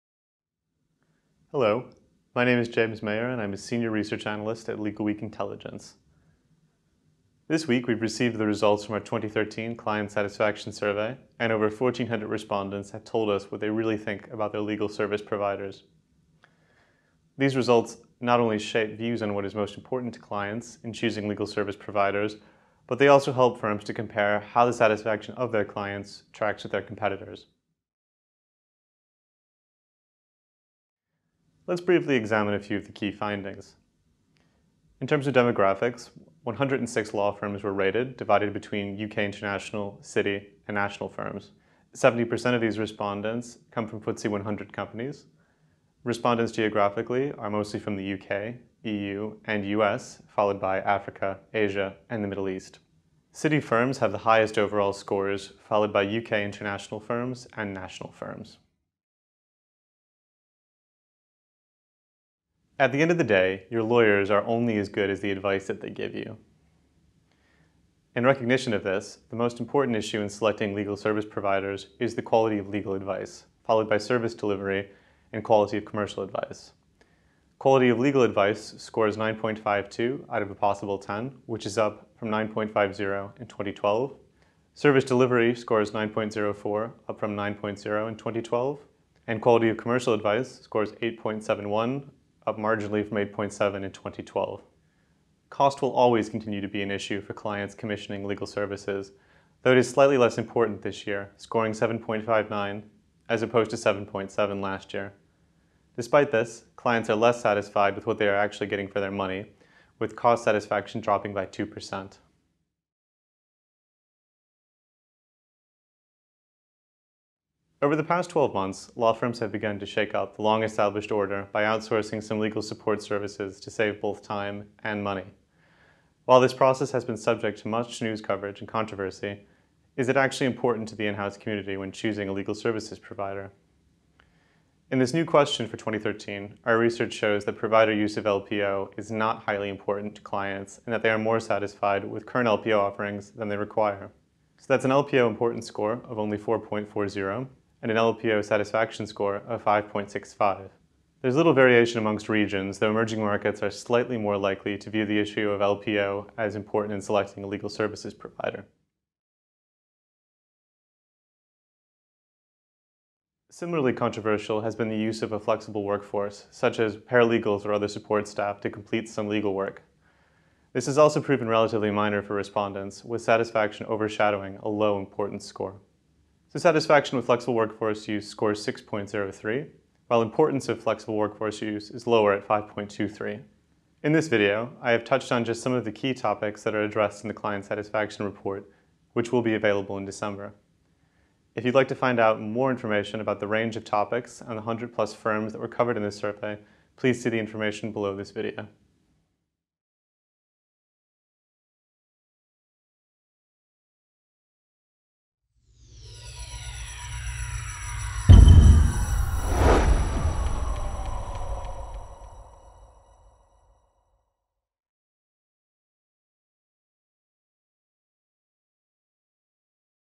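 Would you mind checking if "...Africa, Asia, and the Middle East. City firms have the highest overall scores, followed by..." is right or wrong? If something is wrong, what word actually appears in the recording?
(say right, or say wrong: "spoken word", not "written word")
right.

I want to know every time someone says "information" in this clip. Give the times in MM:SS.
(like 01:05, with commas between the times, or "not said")
03:12, 03:17.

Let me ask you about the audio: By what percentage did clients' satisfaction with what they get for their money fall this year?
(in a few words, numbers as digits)
2%.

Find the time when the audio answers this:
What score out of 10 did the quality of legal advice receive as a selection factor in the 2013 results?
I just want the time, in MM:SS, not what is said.
01:19.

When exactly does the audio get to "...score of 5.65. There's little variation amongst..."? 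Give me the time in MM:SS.
02:29.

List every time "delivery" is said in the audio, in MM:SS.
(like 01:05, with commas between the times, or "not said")
01:14, 01:25.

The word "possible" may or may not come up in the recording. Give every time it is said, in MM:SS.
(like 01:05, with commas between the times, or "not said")
01:20.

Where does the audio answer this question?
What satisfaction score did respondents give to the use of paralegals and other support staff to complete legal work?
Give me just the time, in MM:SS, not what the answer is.
02:58.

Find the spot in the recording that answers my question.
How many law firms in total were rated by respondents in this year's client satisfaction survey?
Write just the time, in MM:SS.
00:36.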